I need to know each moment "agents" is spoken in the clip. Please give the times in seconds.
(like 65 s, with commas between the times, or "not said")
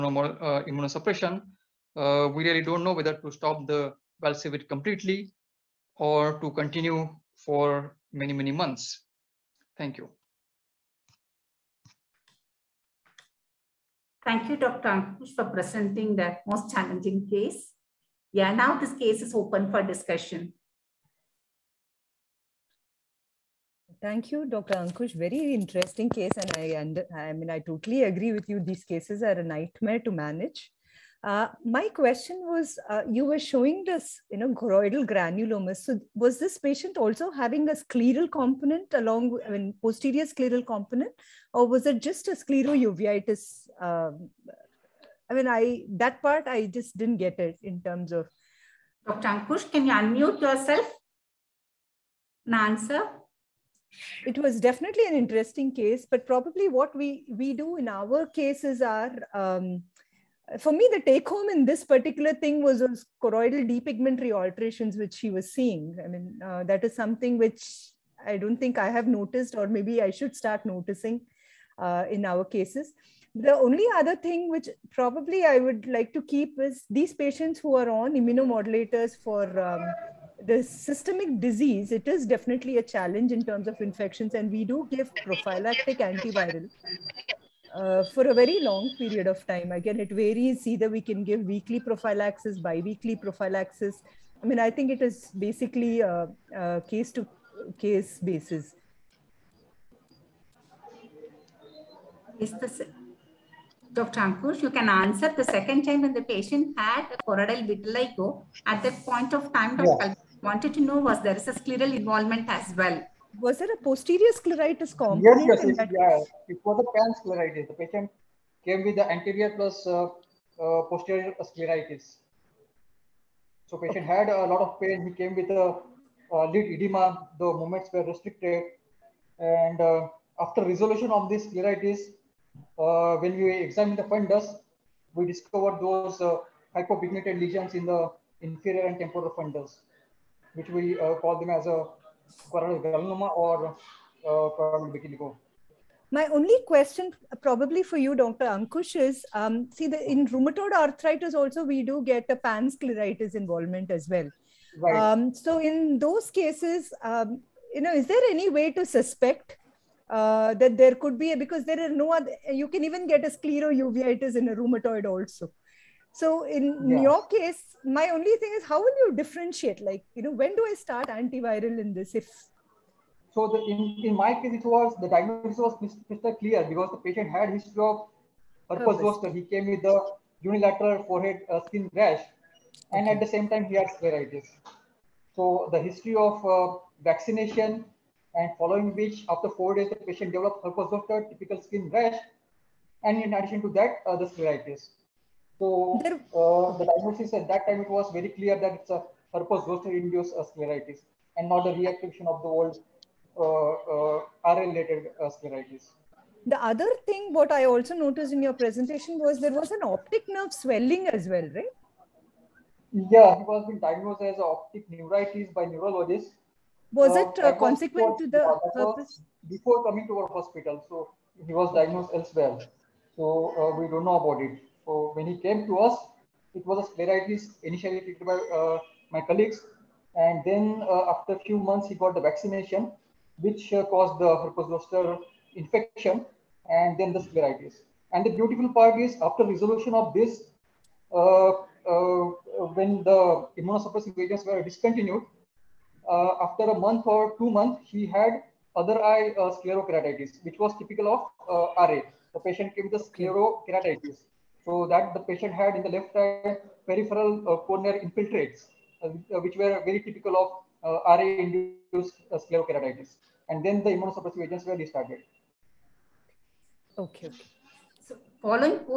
244 s, 264 s.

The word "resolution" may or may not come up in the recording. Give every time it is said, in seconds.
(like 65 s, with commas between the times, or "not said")
130 s, 239 s.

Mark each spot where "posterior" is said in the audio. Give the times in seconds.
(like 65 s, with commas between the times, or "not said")
39 s, 113 s, 120 s.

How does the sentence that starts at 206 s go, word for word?
The other thing what I also noticed in your presentation was there was an optic nerve swelling as well, right?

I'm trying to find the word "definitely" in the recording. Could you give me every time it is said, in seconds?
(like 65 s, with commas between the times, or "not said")
54 s, 82 s.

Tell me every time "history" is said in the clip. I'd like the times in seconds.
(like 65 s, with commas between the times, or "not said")
177 s, 185 s.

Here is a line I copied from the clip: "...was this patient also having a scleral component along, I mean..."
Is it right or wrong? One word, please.
right.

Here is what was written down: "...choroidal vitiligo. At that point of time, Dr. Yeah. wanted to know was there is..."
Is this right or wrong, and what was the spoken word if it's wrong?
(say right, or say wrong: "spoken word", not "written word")
right.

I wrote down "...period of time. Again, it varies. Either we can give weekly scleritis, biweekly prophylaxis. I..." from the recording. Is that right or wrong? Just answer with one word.
wrong.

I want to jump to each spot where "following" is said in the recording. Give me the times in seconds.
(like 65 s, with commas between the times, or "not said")
188 s, 268 s.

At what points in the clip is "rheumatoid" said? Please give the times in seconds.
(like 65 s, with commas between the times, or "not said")
150 s, 164 s.